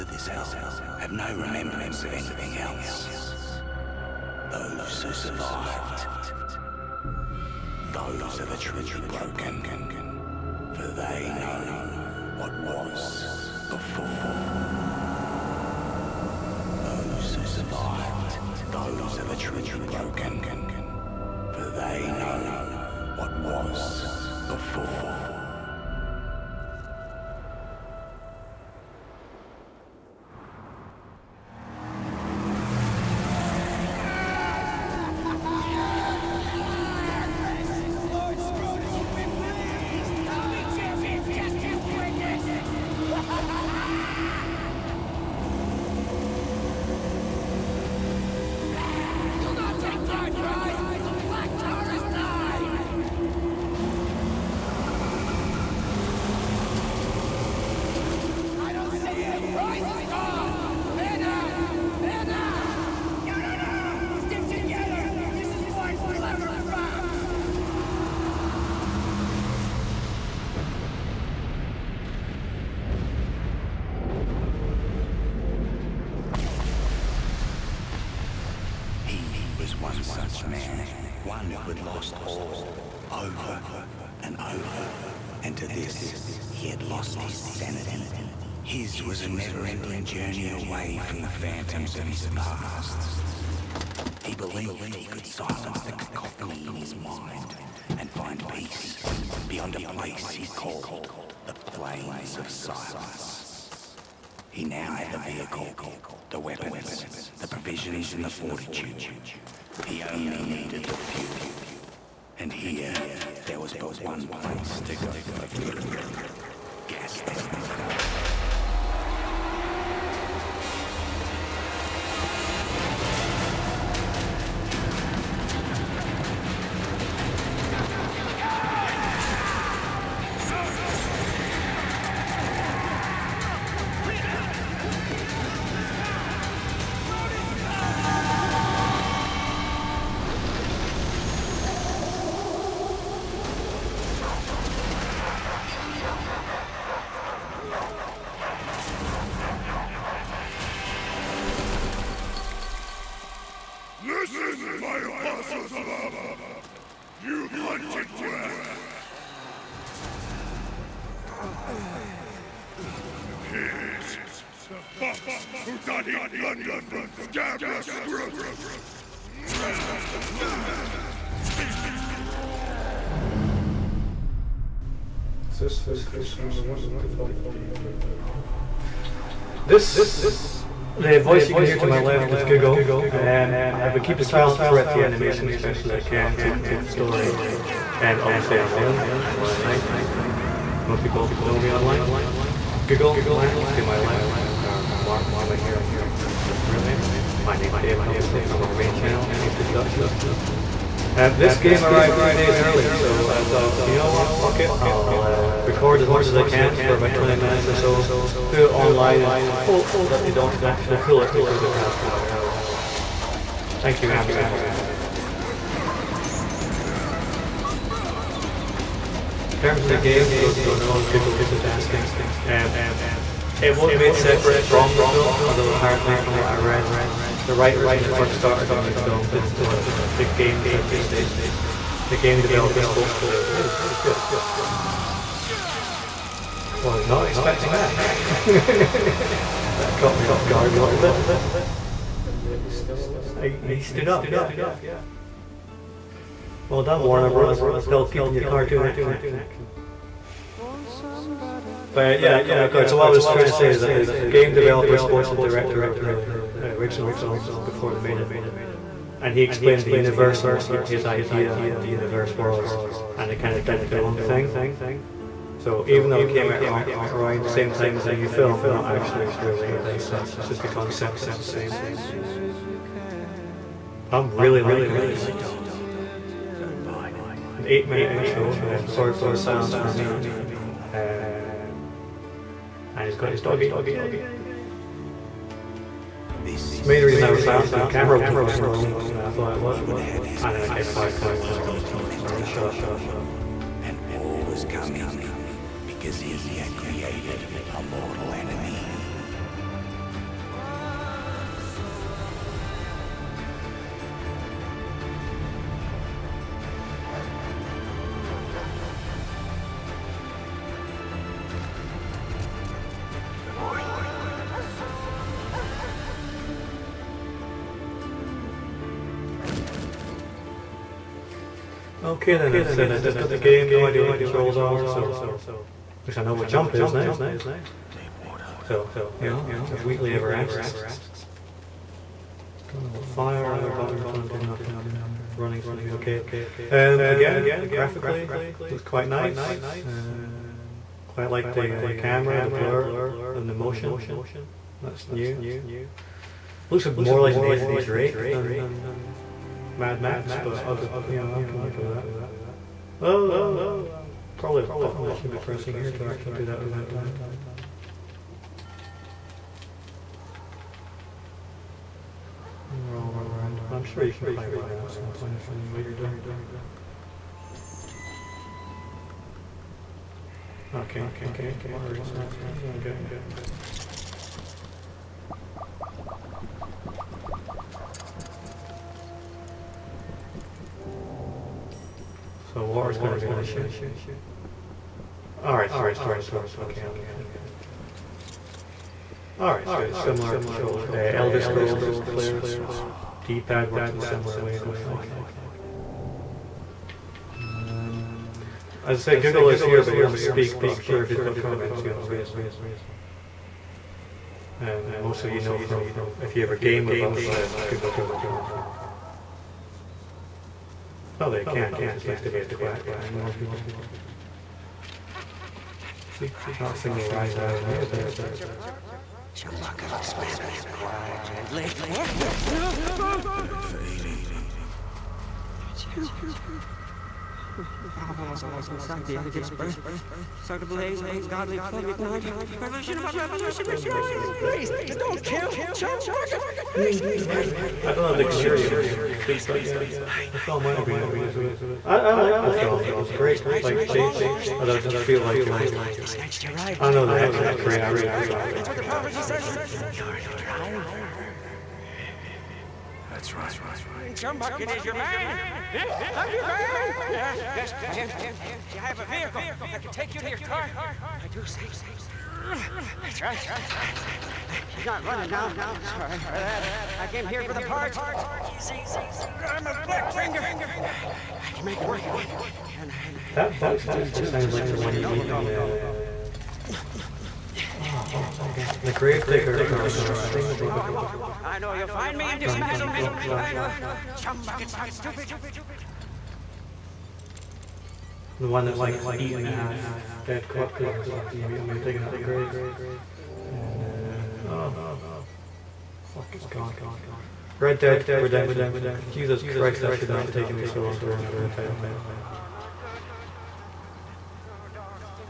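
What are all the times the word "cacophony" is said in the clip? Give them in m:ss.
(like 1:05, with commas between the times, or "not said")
1:35.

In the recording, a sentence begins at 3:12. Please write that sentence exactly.
Google, Mark to my left, Mark, to my here, real name.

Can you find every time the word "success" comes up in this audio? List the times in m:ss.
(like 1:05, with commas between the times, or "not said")
not said.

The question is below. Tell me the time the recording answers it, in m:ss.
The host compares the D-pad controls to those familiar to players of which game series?
6:31.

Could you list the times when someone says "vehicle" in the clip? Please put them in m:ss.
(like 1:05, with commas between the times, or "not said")
1:45, 7:39.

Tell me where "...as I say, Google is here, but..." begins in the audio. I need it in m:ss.
6:38.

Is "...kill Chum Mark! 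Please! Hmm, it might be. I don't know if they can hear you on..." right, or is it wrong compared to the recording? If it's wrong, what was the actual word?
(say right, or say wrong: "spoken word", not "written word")
wrong: "Bucket", not "Mark".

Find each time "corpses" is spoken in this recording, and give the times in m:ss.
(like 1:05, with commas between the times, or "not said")
8:10.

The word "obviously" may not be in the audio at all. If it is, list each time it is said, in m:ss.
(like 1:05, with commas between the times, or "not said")
3:08, 3:18.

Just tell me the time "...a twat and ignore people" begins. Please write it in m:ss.
6:52.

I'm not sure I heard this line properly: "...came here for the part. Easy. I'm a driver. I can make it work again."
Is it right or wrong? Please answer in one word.
wrong.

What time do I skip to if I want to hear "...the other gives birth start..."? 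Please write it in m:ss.
7:09.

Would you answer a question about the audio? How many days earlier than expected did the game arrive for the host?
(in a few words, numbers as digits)
2.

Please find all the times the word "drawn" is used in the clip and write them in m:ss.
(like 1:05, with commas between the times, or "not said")
not said.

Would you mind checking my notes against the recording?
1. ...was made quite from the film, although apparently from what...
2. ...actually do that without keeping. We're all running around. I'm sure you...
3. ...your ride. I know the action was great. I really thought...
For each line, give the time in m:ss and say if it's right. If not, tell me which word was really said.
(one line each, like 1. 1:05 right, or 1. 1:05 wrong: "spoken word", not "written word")
1. 3:43 wrong: "separate", not "quite"
2. 5:56 wrong: "dying", not "keeping"
3. 7:26 right.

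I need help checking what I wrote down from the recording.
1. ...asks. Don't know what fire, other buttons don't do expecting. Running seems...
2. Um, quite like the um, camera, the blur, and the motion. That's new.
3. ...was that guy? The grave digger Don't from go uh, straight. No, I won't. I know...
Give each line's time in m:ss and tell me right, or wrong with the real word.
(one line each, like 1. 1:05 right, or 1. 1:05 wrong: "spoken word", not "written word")
1. 5:30 wrong: "nothing", not "expecting"
2. 5:39 right
3. 7:58 right.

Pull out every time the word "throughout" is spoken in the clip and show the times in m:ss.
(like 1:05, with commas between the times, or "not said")
3:04.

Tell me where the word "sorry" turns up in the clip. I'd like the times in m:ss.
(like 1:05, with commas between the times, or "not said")
4:38, 7:45.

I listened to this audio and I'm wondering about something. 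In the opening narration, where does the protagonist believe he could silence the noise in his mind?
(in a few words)
Plains of Silence.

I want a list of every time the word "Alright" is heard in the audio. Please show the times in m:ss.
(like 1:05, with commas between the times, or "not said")
6:25, 6:29.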